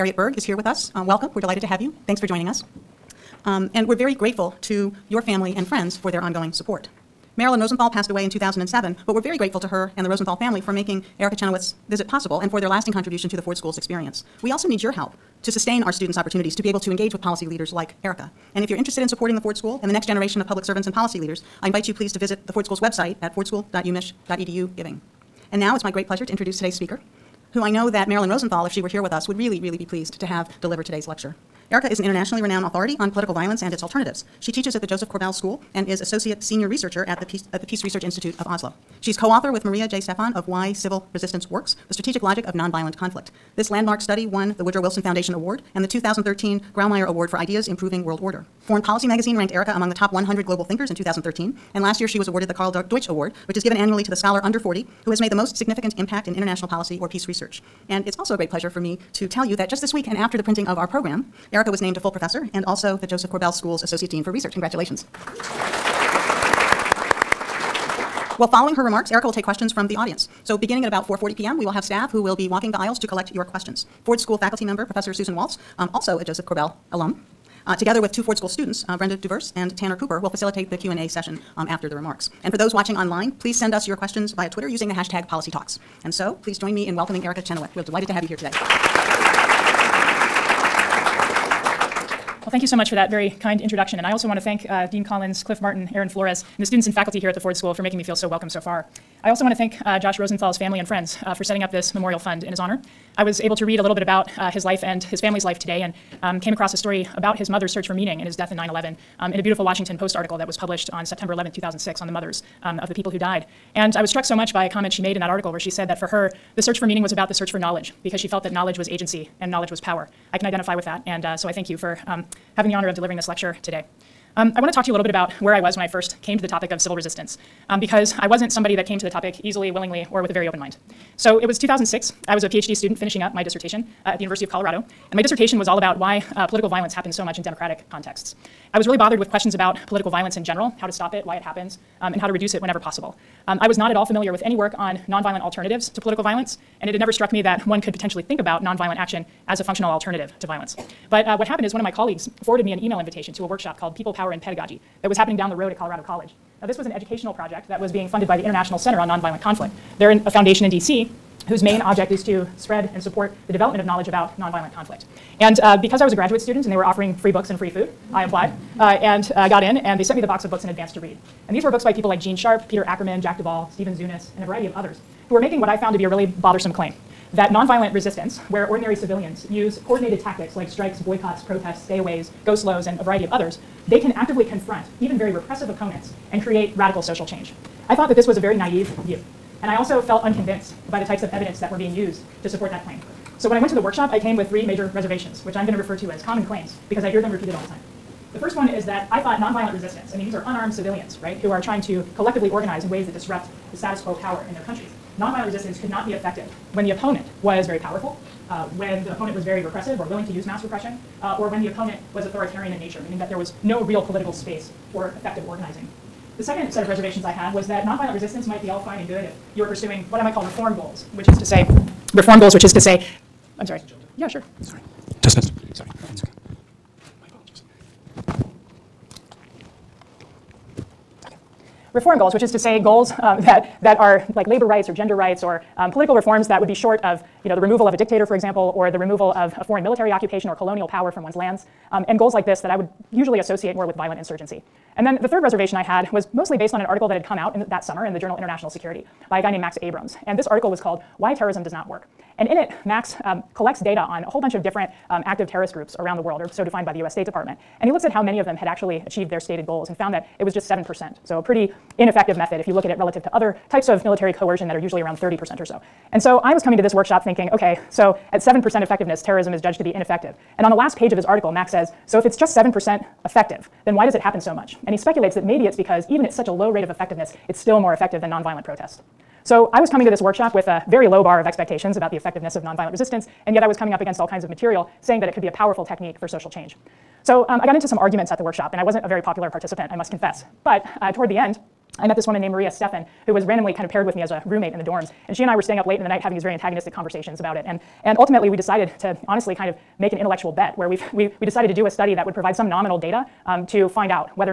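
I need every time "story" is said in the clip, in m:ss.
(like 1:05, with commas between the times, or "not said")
1:46.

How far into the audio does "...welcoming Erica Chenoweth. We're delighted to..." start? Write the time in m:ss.
1:26.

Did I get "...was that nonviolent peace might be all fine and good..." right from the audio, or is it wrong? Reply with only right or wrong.
wrong.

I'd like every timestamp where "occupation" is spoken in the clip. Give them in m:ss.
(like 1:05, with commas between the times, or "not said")
4:00.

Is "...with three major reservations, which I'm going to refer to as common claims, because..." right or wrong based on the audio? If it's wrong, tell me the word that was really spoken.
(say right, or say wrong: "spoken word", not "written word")
right.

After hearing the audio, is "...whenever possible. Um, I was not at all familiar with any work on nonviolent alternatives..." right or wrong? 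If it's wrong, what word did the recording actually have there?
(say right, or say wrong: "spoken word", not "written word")
right.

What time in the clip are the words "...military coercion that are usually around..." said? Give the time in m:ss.
4:24.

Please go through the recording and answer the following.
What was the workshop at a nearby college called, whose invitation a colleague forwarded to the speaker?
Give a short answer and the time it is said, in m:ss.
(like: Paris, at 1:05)
People, Power, and Pedagogy, at 2:33.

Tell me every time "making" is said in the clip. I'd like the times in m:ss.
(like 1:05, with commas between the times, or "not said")
0:10, 1:37, 2:55.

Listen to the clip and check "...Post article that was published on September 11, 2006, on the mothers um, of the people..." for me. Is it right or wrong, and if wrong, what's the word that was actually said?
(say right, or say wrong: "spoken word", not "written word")
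right.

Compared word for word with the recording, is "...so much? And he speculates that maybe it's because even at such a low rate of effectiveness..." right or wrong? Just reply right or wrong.
right.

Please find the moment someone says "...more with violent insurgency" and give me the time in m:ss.
4:03.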